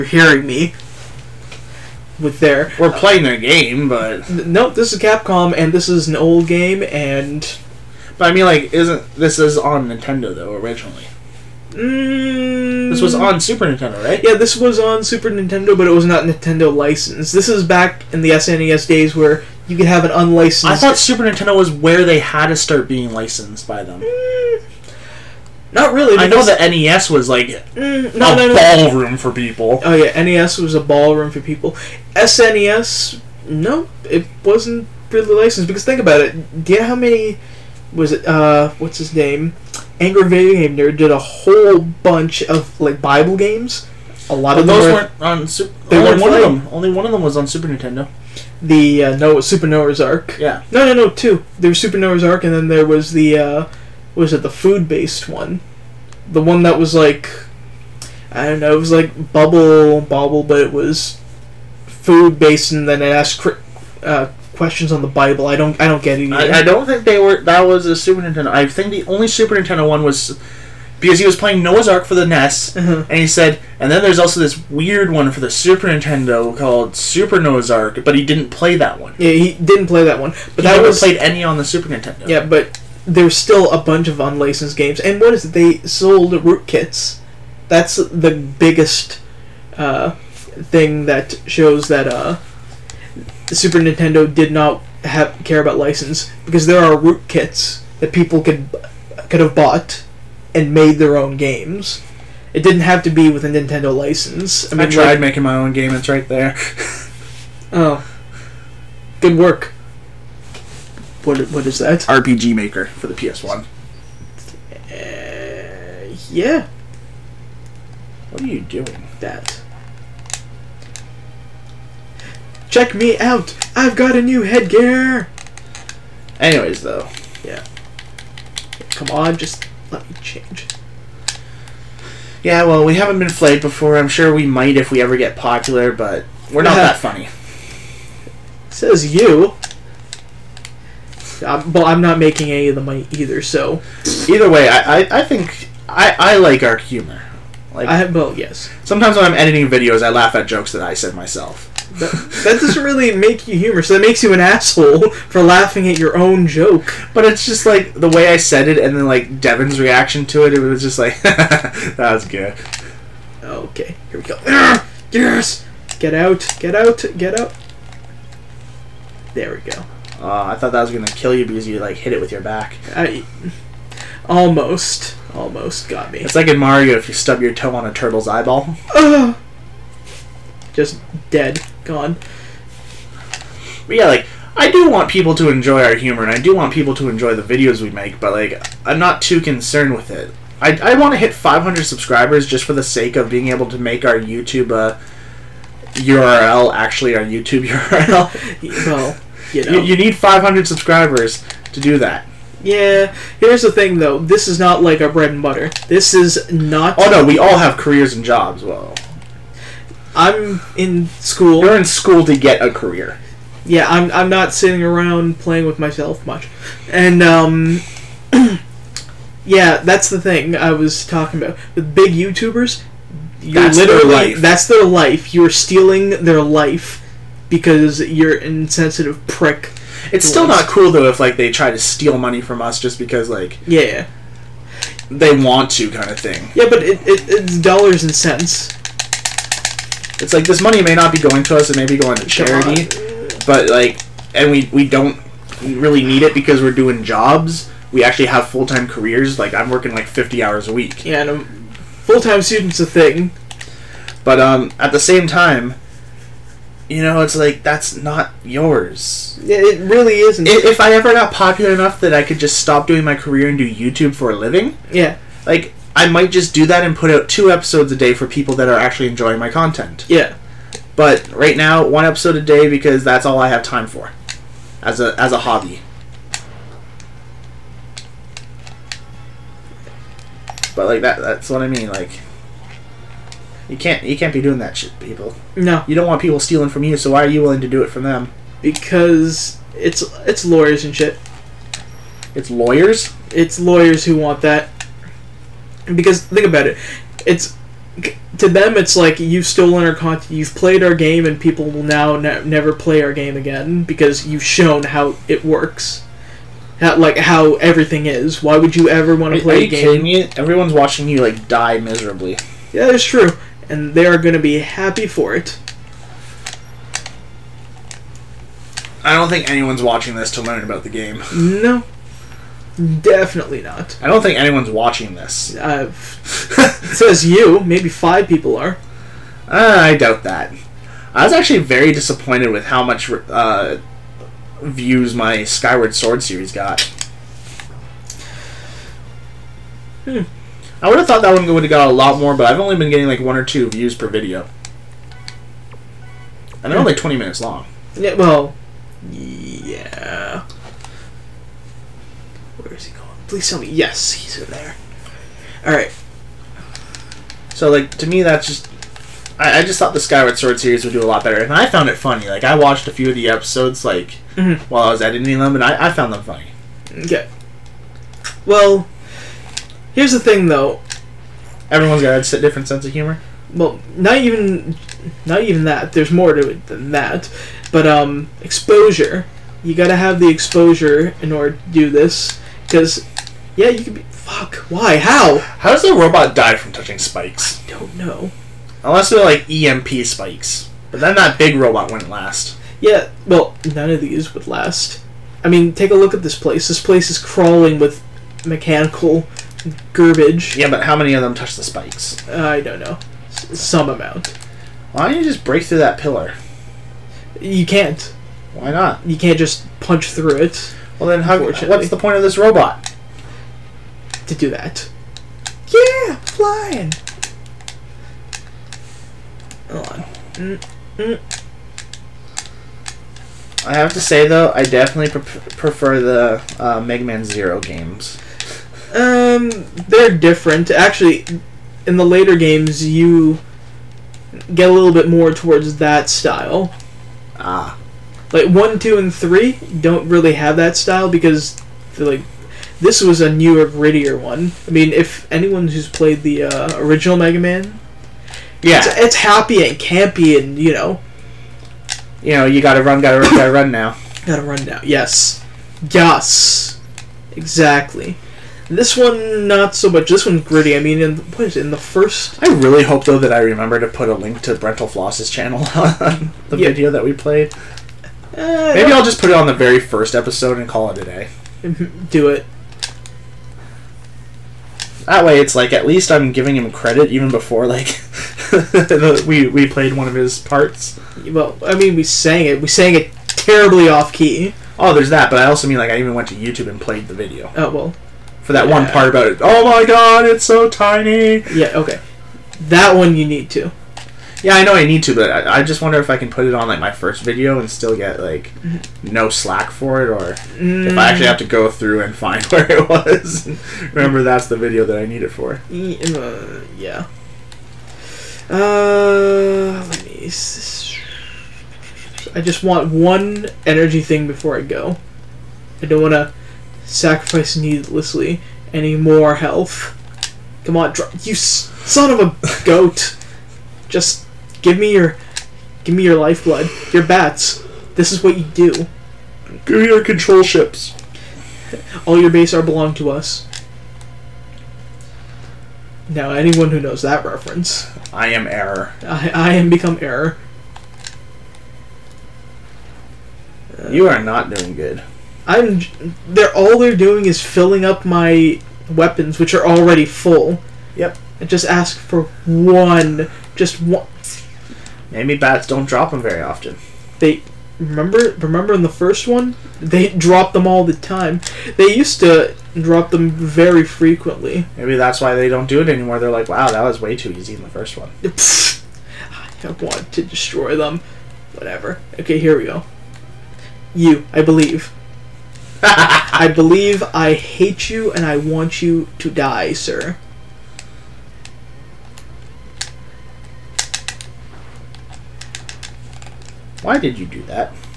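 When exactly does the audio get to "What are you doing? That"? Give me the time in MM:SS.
01:58.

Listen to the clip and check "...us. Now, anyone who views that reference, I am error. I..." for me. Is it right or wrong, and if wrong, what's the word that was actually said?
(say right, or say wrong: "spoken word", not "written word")
wrong: "knows", not "views".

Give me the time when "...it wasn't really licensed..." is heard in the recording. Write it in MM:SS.
00:34.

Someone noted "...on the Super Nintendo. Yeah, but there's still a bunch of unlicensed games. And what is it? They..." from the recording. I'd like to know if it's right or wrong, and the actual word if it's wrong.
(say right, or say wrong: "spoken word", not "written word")
right.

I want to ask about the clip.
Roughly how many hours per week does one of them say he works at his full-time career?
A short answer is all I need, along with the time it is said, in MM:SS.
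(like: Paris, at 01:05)
50, at 04:10.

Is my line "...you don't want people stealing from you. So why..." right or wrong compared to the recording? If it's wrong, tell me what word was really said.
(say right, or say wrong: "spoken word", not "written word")
right.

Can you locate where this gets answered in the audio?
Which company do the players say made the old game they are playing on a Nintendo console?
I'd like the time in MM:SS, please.
00:04.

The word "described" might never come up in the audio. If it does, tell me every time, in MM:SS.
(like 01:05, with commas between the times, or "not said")
not said.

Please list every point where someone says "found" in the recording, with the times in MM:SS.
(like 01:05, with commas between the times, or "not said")
06:01, 06:05.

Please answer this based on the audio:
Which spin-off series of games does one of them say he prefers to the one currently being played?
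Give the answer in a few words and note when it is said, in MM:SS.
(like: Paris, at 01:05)
Mega Man Zero, at 07:06.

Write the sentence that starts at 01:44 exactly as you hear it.
I, mean, I tried like, making my own game.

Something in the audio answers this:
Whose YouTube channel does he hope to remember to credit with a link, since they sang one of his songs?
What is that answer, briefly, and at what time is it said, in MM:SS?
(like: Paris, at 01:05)
Brentalfloss, at 07:44.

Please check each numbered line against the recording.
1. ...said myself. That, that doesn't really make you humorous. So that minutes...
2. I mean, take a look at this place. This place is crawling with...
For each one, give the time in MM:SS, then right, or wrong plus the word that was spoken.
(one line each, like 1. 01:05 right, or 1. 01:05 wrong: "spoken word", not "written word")
1. 02:30 wrong: "makes", not "minutes"
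2. 06:35 right.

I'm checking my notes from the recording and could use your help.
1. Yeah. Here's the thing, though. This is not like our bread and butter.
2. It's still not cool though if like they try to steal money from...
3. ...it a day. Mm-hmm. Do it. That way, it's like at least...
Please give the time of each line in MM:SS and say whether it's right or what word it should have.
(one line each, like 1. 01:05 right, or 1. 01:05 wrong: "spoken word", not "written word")
1. 03:22 right
2. 03:50 right
3. 07:50 right.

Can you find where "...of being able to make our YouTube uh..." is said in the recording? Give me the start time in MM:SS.
03:13.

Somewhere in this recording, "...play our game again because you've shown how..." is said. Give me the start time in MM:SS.
05:02.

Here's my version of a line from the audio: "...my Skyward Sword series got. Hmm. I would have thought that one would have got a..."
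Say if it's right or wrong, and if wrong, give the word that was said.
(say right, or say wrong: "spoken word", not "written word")
right.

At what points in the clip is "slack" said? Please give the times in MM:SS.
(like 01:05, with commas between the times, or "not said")
08:19.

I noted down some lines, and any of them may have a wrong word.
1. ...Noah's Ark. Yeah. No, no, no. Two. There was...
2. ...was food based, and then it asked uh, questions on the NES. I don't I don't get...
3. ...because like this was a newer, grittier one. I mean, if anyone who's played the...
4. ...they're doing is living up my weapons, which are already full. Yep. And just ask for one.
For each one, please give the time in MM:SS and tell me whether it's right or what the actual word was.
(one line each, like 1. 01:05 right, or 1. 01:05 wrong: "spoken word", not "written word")
1. 00:49 right
2. 01:00 wrong: "Bible", not "NES"
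3. 07:21 right
4. 09:06 wrong: "filling", not "living".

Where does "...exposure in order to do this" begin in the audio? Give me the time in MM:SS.
06:20.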